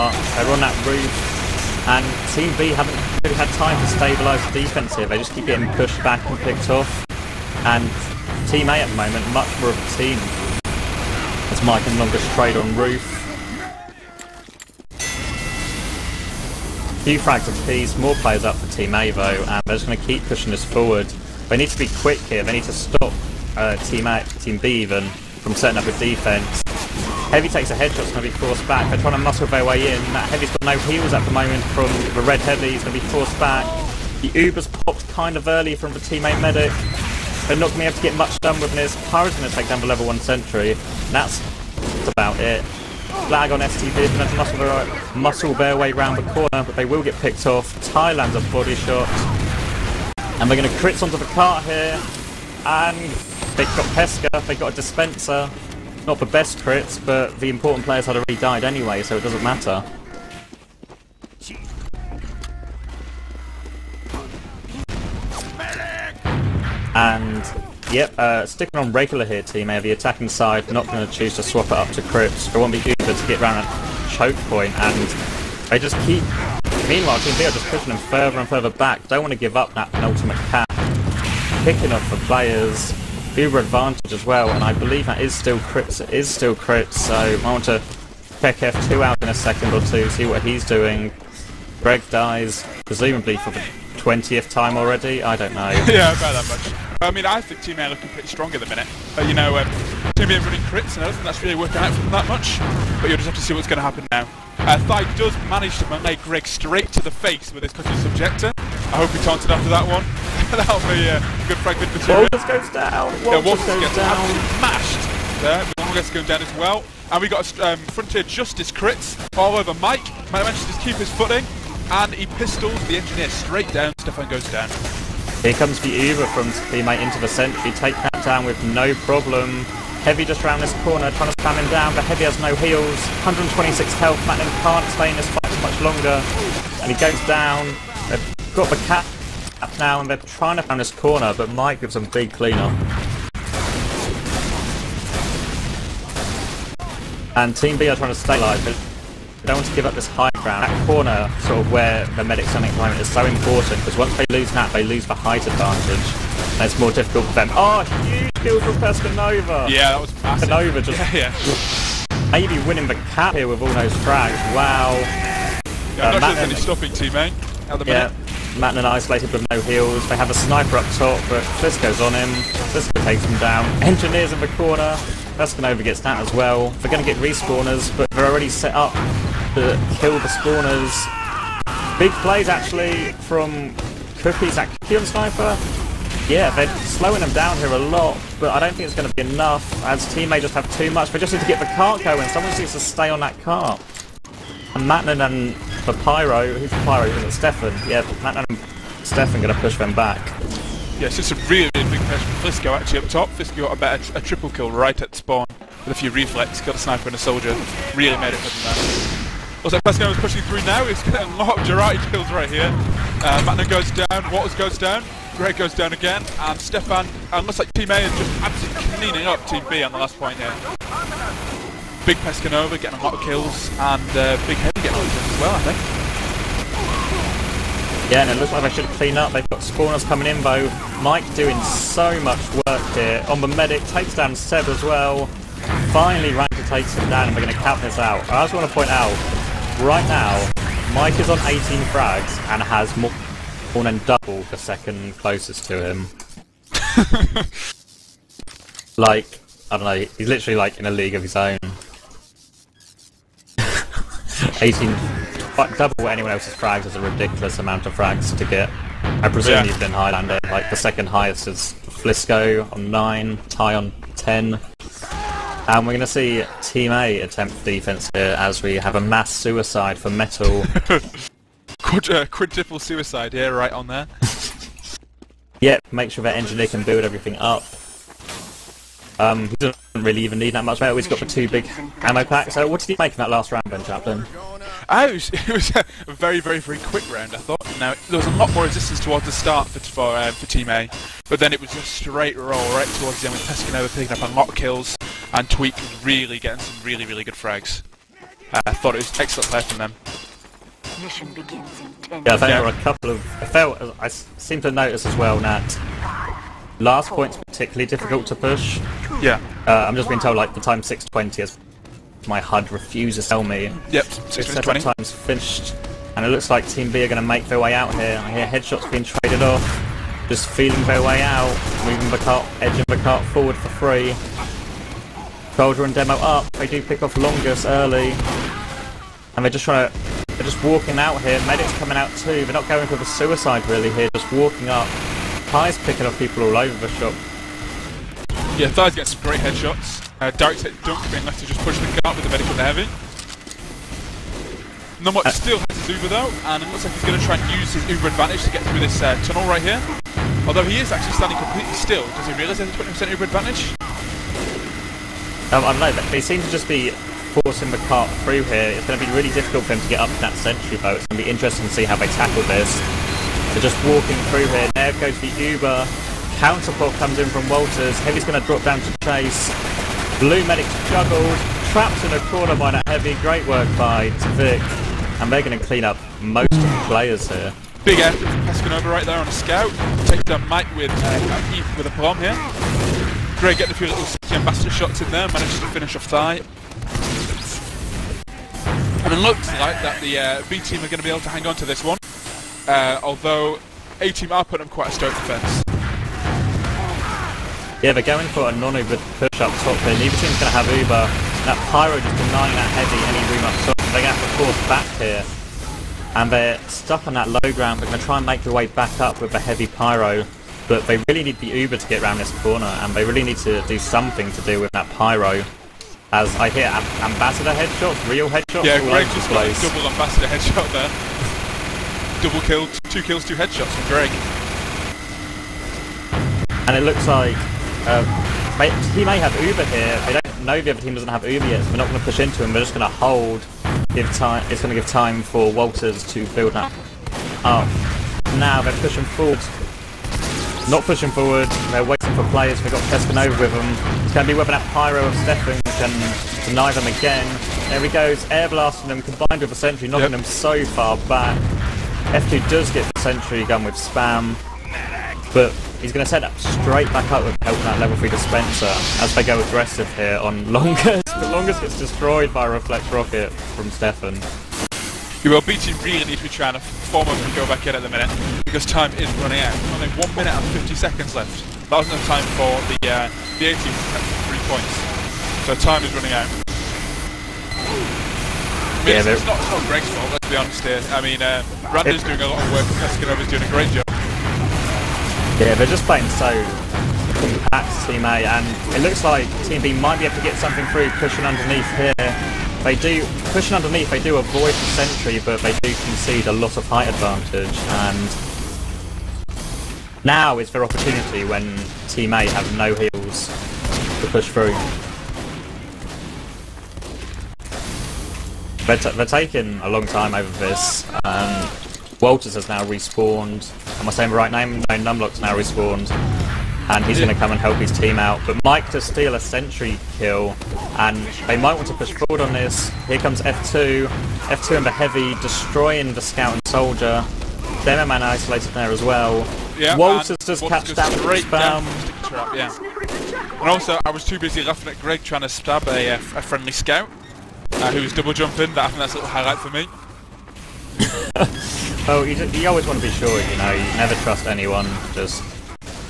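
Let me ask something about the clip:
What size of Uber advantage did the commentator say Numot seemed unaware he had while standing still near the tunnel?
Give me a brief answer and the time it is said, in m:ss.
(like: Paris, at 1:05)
20%, at 5:53.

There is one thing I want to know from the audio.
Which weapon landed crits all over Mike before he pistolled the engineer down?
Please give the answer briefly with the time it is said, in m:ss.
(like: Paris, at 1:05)
Frontier Justice, at 1:57.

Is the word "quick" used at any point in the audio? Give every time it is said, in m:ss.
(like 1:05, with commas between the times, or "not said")
0:22, 4:46.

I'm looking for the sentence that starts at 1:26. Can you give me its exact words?
It is still crits, so I want to check F2 out in a second or two, see what he's doing.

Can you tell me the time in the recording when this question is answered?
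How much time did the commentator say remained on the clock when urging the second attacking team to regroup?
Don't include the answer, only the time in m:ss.
7:49.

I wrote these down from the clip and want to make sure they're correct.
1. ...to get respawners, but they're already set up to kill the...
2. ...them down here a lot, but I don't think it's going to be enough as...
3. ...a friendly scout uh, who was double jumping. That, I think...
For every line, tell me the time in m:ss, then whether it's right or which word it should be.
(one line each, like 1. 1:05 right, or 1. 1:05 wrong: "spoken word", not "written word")
1. 2:57 right
2. 3:07 right
3. 8:55 right.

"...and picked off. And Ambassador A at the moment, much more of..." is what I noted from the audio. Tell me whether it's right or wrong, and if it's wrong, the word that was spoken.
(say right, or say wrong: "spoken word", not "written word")
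wrong: "Team", not "Ambassador".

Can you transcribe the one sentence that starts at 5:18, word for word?
I hear headshots being traded off.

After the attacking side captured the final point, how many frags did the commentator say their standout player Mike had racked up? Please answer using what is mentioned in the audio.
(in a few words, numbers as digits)
18.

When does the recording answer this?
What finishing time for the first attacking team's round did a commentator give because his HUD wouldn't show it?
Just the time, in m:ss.
5:10.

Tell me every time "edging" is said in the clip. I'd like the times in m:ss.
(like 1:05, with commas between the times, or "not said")
5:22.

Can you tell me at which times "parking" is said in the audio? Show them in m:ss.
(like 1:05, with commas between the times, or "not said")
not said.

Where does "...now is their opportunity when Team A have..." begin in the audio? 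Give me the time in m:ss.
8:20.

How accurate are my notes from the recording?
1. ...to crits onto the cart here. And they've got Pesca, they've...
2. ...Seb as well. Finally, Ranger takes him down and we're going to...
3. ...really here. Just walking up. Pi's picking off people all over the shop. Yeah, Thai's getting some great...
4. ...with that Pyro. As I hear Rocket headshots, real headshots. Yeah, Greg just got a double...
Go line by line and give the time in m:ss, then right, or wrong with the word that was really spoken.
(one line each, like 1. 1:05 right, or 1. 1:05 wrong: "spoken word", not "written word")
1. 0:50 right
2. 3:54 right
3. 5:33 right
4. 6:54 wrong: "Ambassador", not "Rocket".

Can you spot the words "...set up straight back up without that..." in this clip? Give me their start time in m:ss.
7:36.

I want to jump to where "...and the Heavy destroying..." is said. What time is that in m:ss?
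8:44.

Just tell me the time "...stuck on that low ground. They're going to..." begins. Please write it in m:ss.
6:46.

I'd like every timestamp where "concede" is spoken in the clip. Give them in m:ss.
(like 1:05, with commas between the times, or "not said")
8:15.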